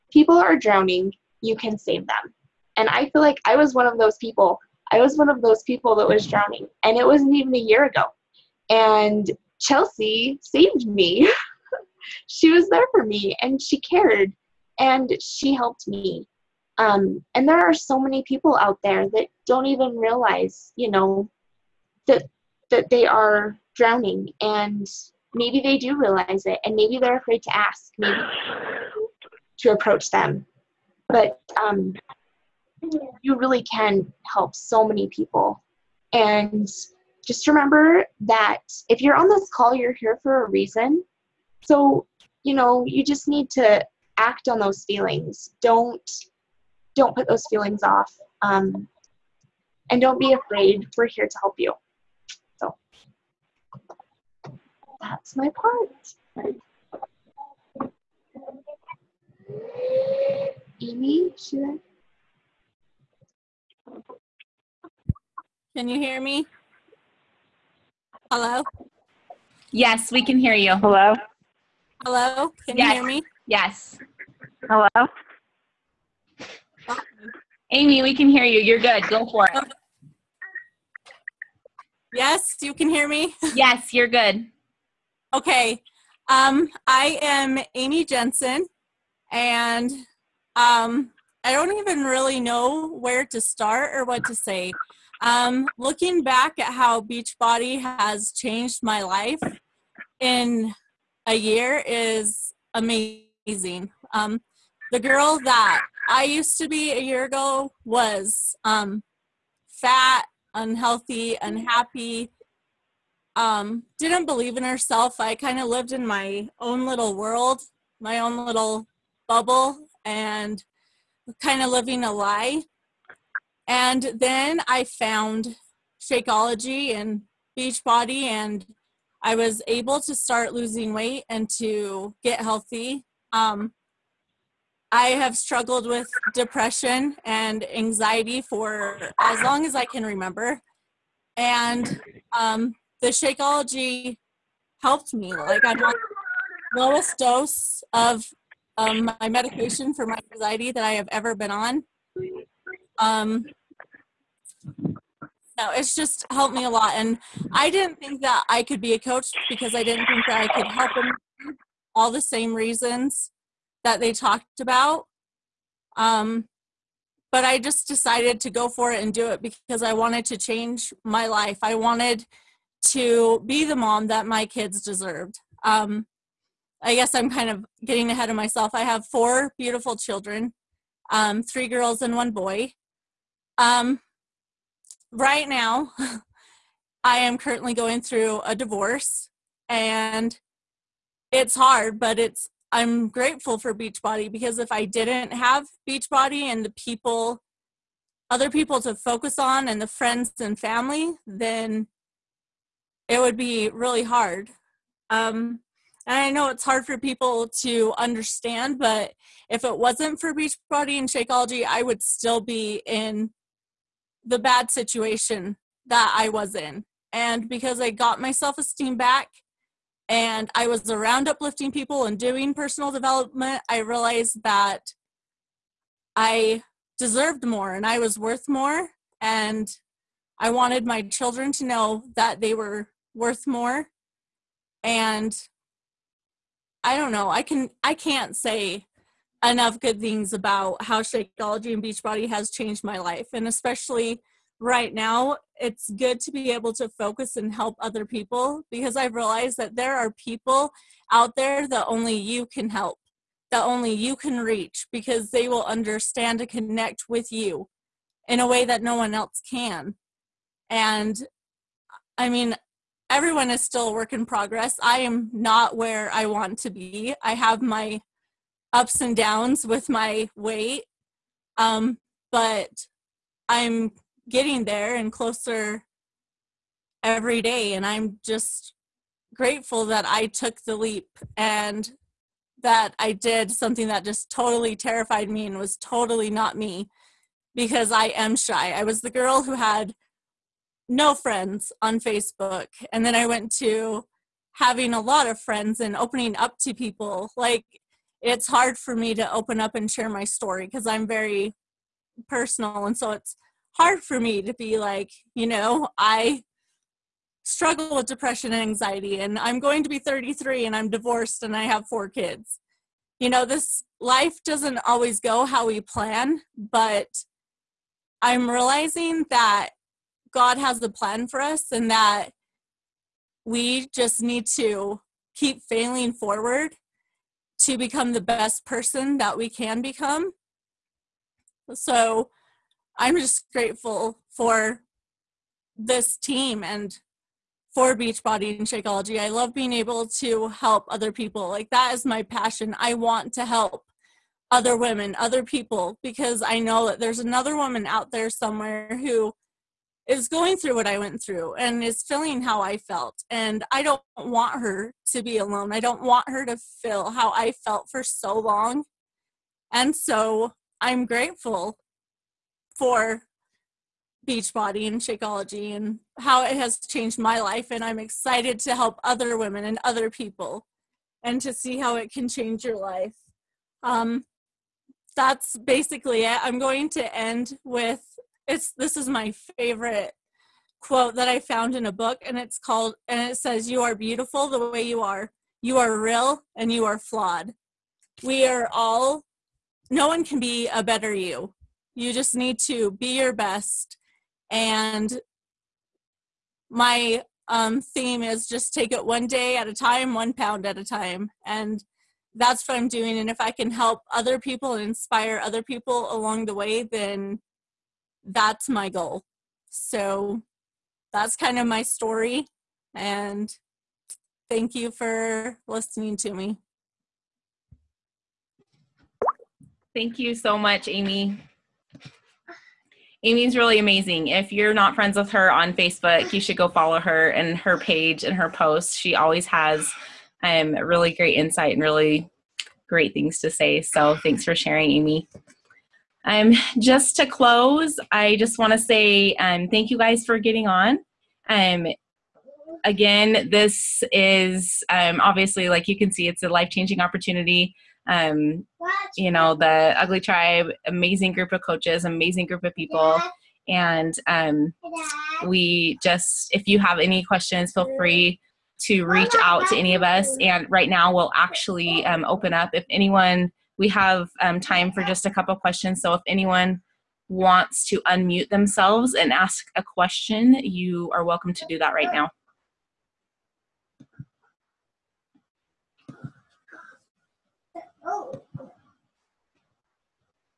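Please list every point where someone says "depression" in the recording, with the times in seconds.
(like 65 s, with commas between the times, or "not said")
136 s, 308 s.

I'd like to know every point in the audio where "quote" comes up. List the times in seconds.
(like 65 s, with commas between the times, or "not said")
380 s.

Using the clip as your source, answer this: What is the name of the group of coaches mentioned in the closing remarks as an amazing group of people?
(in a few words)
Ugly Tribe.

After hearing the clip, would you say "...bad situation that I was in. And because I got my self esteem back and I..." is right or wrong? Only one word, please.
right.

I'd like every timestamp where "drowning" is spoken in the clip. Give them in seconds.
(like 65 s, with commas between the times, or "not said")
0 s, 6 s, 23 s.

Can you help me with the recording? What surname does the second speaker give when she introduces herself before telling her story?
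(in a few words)
Jensen.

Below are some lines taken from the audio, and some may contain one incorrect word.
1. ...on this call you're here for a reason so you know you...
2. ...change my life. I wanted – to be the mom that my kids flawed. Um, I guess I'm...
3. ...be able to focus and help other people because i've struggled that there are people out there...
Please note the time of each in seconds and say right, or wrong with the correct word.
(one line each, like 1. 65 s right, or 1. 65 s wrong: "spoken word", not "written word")
1. 39 s right
2. 170 s wrong: "deserved", not "flawed"
3. 246 s wrong: "realized", not "struggled".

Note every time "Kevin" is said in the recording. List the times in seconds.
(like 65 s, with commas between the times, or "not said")
not said.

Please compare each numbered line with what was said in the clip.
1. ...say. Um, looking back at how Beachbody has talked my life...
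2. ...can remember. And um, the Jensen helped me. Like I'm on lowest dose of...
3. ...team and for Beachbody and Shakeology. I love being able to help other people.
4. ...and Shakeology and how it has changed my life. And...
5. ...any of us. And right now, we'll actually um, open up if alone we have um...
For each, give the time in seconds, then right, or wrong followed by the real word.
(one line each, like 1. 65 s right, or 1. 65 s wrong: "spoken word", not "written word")
1. 94 s wrong: "changed", not "talked"
2. 139 s wrong: "Shakeology", not "Jensen"
3. 336 s right
4. 364 s right
5. 459 s wrong: "anyone", not "alone".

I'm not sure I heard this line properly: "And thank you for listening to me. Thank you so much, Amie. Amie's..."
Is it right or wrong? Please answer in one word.
right.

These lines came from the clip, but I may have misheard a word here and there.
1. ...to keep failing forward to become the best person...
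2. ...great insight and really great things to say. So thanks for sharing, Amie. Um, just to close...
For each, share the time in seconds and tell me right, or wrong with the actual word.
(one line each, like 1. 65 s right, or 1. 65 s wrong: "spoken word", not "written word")
1. 324 s right
2. 431 s right.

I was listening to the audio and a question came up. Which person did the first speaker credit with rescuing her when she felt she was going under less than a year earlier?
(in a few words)
Cheltzey.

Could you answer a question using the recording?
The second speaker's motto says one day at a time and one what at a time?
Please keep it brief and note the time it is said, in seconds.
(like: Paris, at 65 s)
one pound, at 400 s.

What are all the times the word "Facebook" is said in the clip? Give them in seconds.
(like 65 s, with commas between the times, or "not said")
292 s, 425 s.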